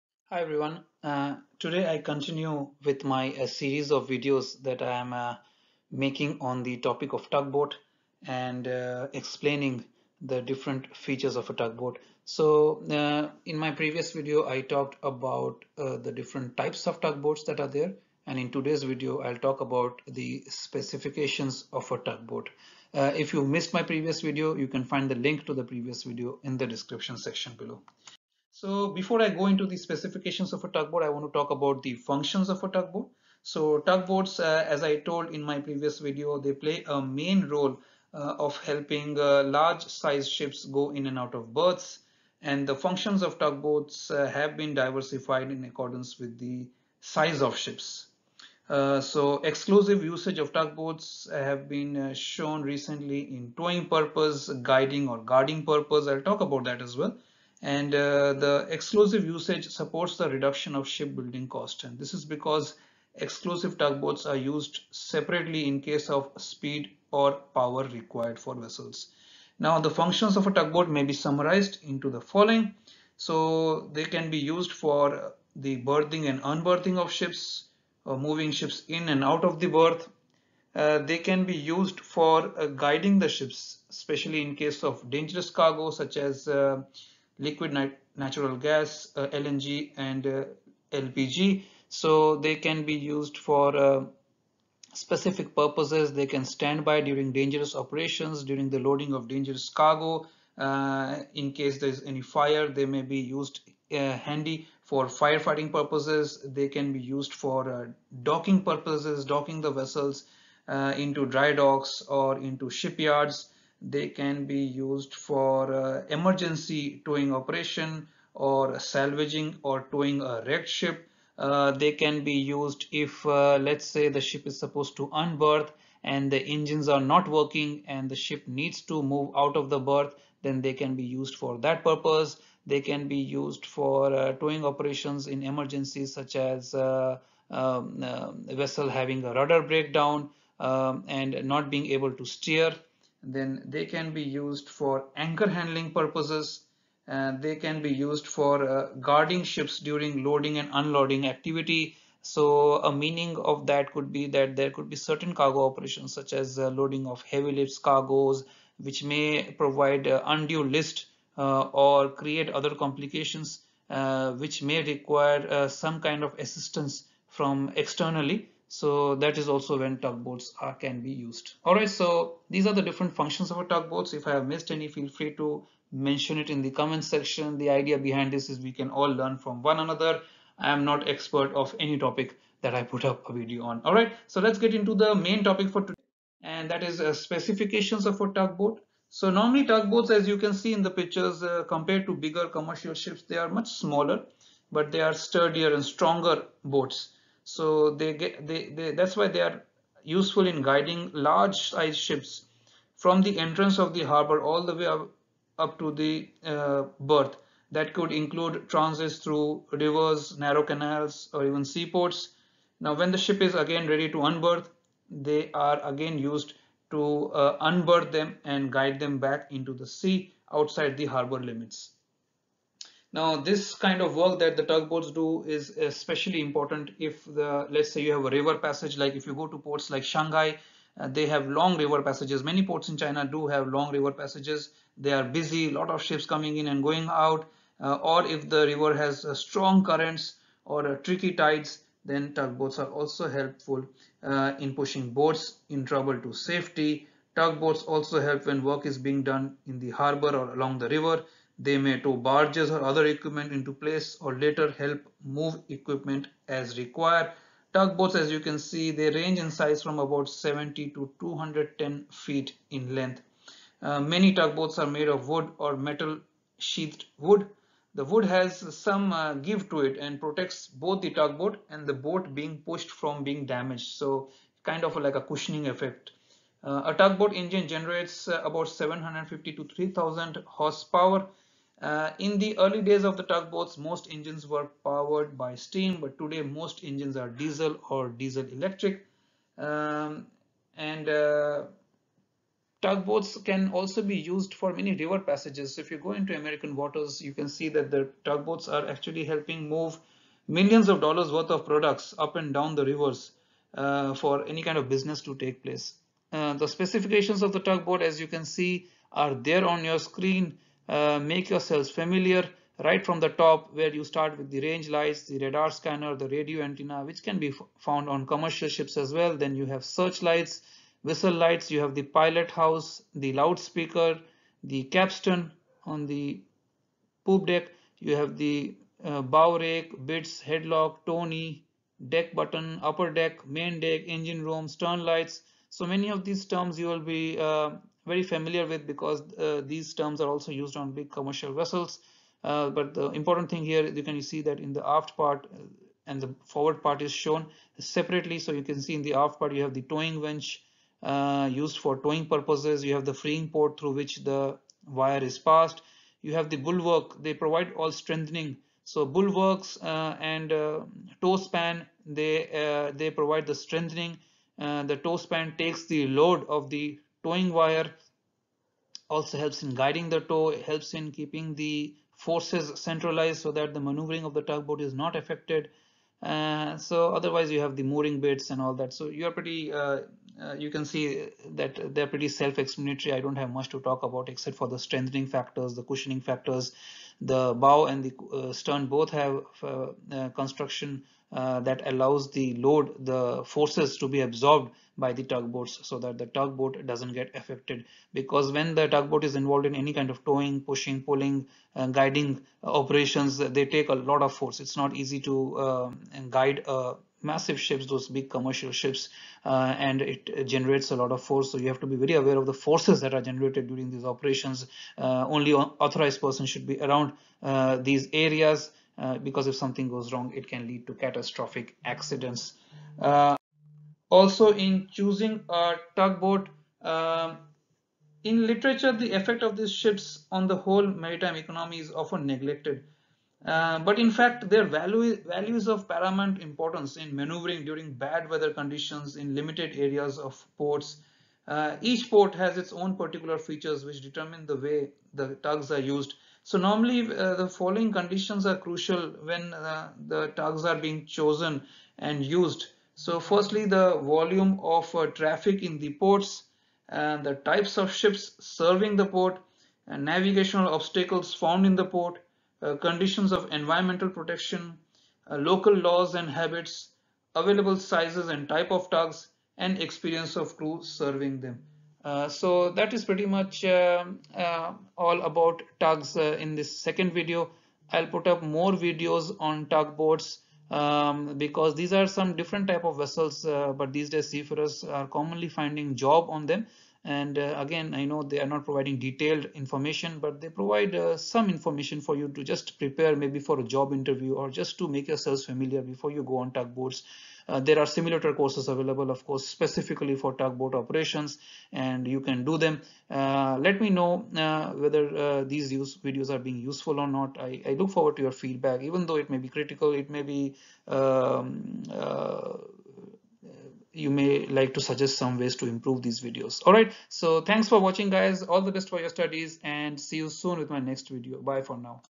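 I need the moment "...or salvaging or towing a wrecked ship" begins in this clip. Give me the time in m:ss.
1:58.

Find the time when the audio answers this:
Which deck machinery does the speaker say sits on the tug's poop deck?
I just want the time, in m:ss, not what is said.
5:24.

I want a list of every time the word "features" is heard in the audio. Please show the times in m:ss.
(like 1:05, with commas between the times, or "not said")
0:10, 7:23.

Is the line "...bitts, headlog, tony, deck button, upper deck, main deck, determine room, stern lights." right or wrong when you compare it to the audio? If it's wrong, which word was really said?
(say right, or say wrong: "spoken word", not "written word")
wrong: "engine", not "determine".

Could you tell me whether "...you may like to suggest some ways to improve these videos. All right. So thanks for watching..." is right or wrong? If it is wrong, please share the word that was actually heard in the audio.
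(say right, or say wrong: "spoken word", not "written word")
right.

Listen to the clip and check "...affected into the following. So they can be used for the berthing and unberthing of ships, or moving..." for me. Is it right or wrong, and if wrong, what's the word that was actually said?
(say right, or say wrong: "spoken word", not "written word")
wrong: "summarized", not "affected".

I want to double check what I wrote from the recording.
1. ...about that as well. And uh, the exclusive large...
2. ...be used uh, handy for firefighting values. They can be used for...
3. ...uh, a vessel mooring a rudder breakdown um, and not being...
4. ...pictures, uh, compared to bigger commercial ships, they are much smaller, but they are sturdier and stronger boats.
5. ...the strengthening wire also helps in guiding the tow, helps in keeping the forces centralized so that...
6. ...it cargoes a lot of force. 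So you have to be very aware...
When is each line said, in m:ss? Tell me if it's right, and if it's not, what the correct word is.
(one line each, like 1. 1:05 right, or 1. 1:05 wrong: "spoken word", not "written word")
1. 0:56 wrong: "usage", not "large"
2. 1:43 wrong: "purposes", not "values"
3. 2:18 wrong: "having", not "mooring"
4. 3:10 right
5. 6:06 wrong: "towing", not "strengthening"
6. 6:50 wrong: "generates", not "cargoes".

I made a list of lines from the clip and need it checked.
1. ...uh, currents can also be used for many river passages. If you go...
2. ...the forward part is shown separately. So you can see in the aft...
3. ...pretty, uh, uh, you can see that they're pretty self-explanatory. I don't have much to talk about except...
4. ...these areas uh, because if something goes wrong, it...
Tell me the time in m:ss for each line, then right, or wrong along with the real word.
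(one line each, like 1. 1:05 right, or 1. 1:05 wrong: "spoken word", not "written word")
1. 4:51 wrong: "tugboats", not "currents"
2. 5:46 right
3. 6:19 right
4. 6:57 right.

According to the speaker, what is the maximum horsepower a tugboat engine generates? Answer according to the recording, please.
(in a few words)
3000 horsepower.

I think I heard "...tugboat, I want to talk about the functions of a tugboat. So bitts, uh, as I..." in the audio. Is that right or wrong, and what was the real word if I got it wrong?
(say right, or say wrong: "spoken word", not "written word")
wrong: "tugboats", not "bitts".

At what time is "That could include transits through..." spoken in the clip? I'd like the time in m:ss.
3:27.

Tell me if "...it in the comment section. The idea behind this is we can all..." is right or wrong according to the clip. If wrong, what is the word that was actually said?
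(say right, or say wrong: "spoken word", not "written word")
right.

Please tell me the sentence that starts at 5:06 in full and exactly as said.
Uh, the specifications of the tugboat, as you can see, are there on your screen.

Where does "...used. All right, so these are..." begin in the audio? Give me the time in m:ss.
2:51.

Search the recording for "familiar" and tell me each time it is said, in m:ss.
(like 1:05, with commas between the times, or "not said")
5:11, 5:38, 8:15.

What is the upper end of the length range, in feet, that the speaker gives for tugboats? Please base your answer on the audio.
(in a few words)
210 feet.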